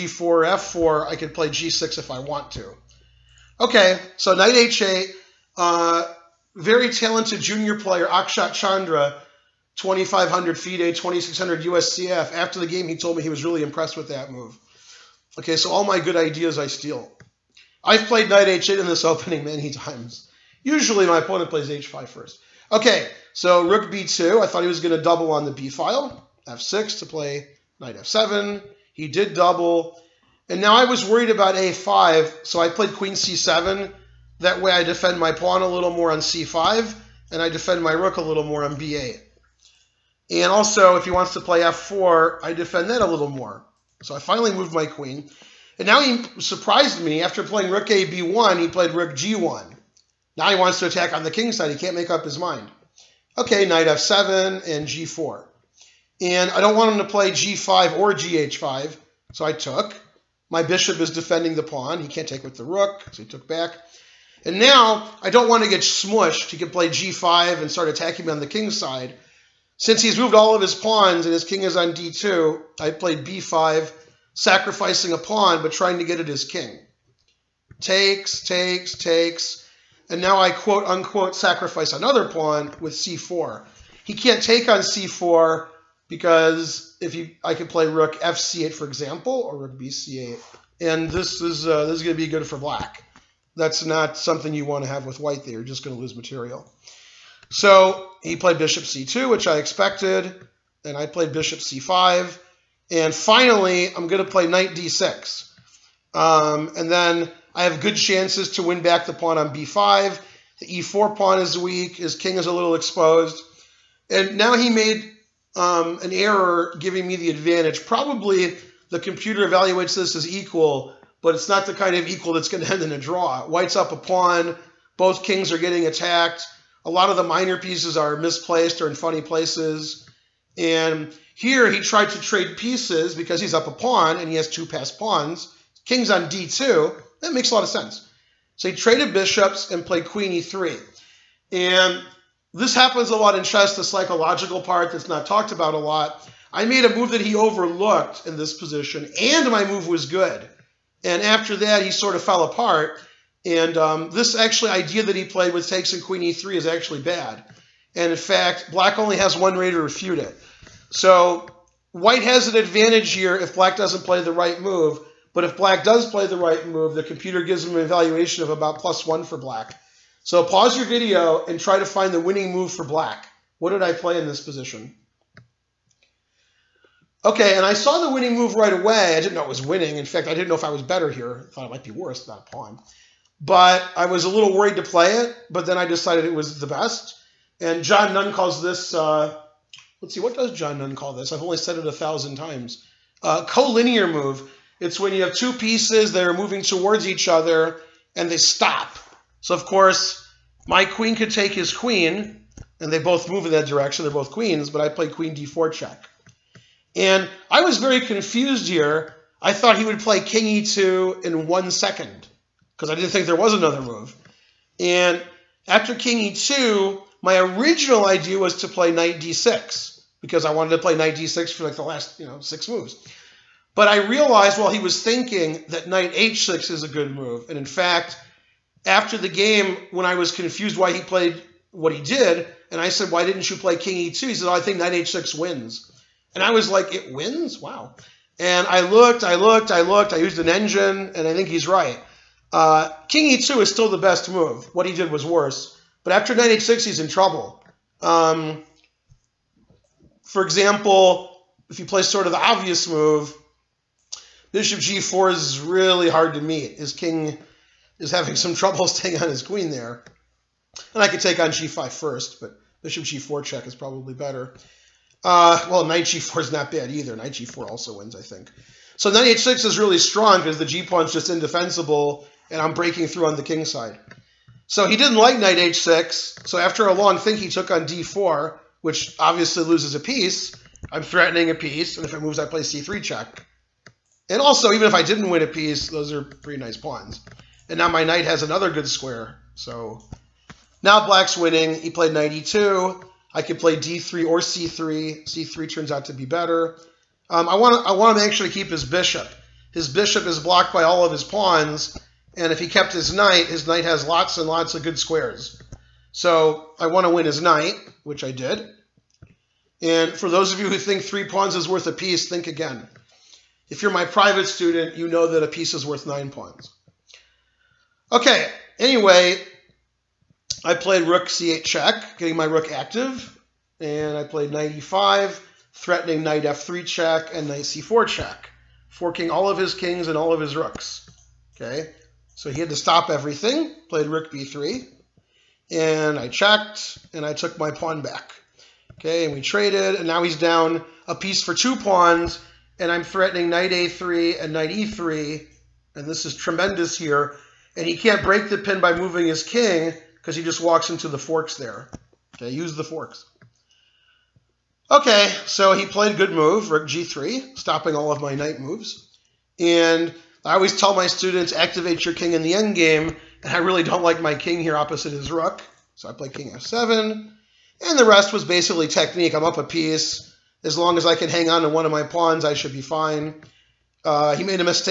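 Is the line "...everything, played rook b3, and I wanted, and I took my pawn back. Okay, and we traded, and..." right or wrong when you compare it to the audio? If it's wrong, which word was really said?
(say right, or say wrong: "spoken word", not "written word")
wrong: "checked", not "wanted".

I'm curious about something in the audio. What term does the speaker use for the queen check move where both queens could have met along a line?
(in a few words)
collinear move.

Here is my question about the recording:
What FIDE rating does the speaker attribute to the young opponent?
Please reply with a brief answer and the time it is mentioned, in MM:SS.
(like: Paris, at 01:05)
2500, at 00:09.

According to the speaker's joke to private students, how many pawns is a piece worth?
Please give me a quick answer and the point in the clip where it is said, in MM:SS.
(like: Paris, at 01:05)
9, at 05:16.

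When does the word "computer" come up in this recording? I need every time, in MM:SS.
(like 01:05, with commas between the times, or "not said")
01:58, 02:47.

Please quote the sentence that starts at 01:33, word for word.
That's not something you want to have with white there.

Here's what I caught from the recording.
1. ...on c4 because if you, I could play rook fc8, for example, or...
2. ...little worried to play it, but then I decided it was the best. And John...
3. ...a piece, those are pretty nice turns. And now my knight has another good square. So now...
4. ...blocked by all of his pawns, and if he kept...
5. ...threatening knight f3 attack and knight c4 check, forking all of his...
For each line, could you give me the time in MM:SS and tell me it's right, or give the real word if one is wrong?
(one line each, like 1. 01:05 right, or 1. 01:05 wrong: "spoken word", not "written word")
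1. 01:24 right
2. 03:04 right
3. 04:45 wrong: "pawns", not "turns"
4. 05:00 right
5. 05:25 wrong: "check", not "attack".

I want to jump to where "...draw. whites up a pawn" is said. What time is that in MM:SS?
02:02.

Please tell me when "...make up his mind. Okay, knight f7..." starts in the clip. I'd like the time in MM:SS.
00:51.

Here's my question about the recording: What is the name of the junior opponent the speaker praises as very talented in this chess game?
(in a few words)
Akshat Chandra.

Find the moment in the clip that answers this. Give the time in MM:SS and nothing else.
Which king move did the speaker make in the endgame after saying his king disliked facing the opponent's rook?
06:06.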